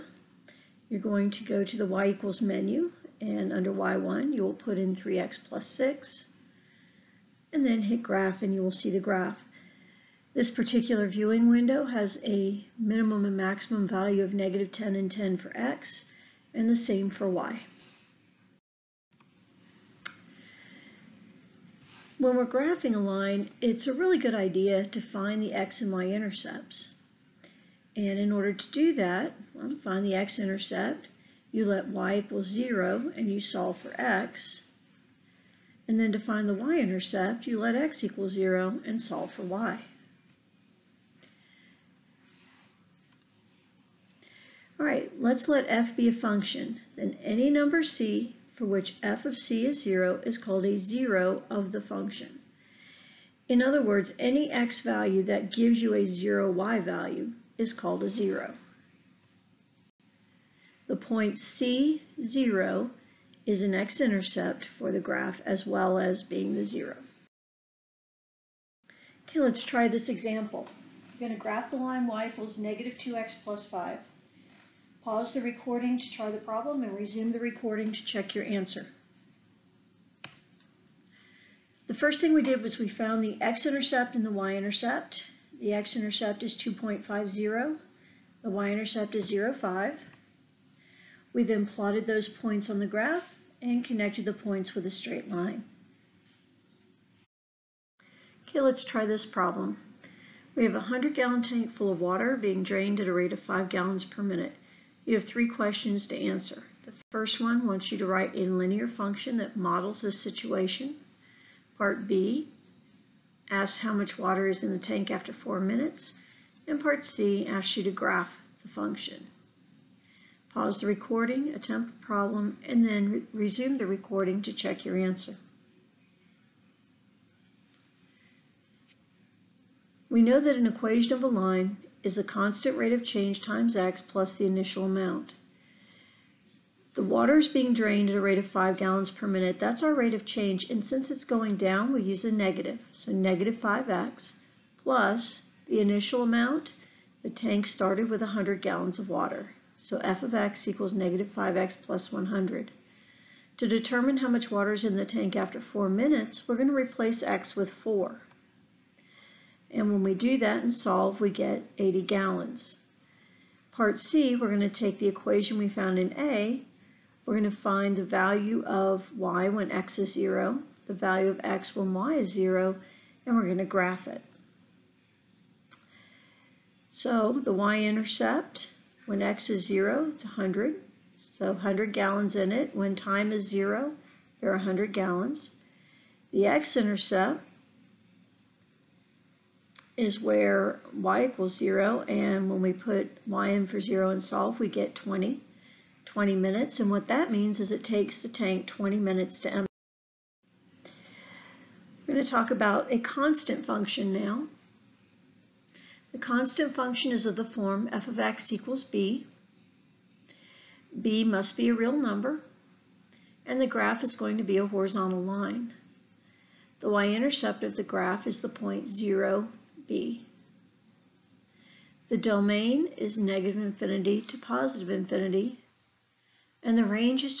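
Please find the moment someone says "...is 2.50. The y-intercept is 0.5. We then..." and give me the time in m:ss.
1:26.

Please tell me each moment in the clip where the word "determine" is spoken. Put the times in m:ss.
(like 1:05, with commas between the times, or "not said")
2:33.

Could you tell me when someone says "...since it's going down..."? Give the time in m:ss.
2:20.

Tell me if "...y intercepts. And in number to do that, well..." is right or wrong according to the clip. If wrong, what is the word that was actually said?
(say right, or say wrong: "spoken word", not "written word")
wrong: "order", not "number".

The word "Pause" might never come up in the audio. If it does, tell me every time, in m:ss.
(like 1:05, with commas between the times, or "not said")
1:15, 2:00.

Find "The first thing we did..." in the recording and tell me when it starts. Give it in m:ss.
1:21.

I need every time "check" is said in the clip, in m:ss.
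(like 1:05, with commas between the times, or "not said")
1:18, 2:04.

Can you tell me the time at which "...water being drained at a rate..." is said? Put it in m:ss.
1:42.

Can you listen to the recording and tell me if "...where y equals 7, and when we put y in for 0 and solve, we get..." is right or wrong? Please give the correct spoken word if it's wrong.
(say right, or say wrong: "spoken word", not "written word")
wrong: "0", not "7".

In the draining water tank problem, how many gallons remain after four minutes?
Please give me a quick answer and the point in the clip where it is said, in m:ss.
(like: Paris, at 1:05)
80 gallons, at 2:41.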